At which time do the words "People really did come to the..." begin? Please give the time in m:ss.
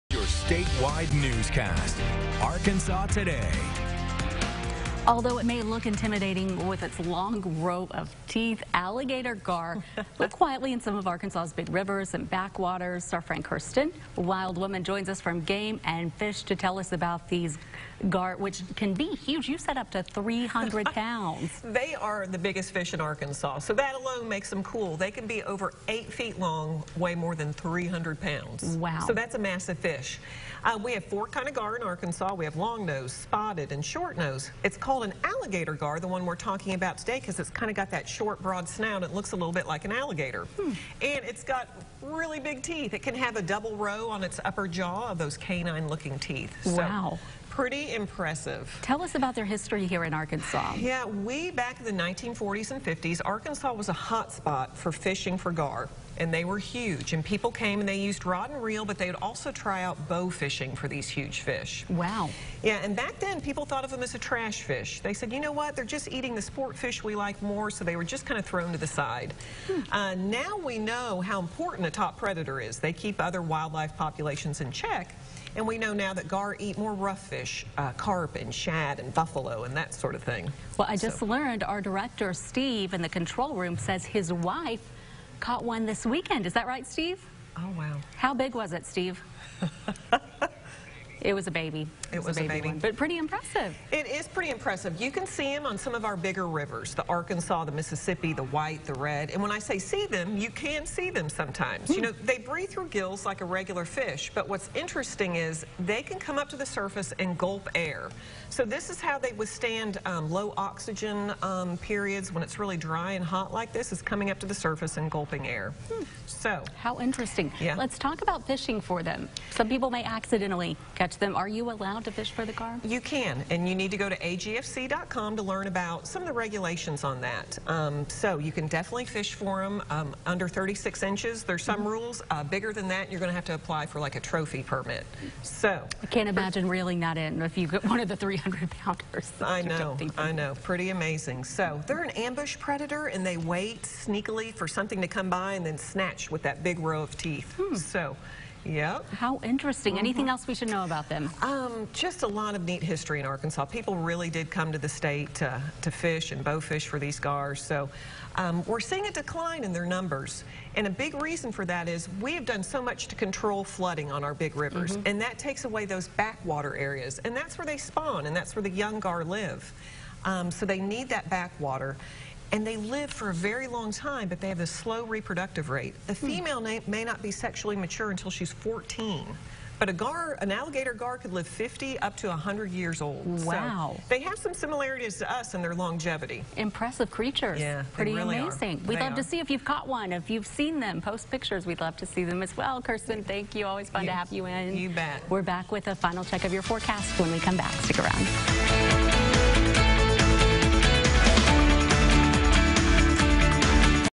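2:33.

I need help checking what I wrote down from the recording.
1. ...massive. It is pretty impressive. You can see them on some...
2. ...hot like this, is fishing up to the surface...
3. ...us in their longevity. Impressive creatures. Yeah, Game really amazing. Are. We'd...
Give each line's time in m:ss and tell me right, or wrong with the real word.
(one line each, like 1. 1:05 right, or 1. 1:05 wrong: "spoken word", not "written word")
1. 1:33 wrong: "impressive", not "massive"
2. 1:53 wrong: "coming", not "fishing"
3. 3:05 wrong: "Pretty", not "Game".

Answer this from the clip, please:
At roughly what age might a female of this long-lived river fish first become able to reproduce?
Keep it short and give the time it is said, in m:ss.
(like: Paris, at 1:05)
14, at 2:58.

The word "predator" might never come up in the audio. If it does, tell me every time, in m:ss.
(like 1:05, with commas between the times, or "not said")
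1:12, 2:22.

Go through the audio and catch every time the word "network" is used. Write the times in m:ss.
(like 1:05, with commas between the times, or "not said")
not said.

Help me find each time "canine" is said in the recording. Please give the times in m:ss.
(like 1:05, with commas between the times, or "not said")
0:45.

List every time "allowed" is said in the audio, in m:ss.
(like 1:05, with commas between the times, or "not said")
2:01.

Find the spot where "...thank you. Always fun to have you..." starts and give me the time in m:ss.
3:13.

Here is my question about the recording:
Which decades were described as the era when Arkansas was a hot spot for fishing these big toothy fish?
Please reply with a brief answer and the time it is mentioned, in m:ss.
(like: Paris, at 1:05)
1940s and 50s, at 0:52.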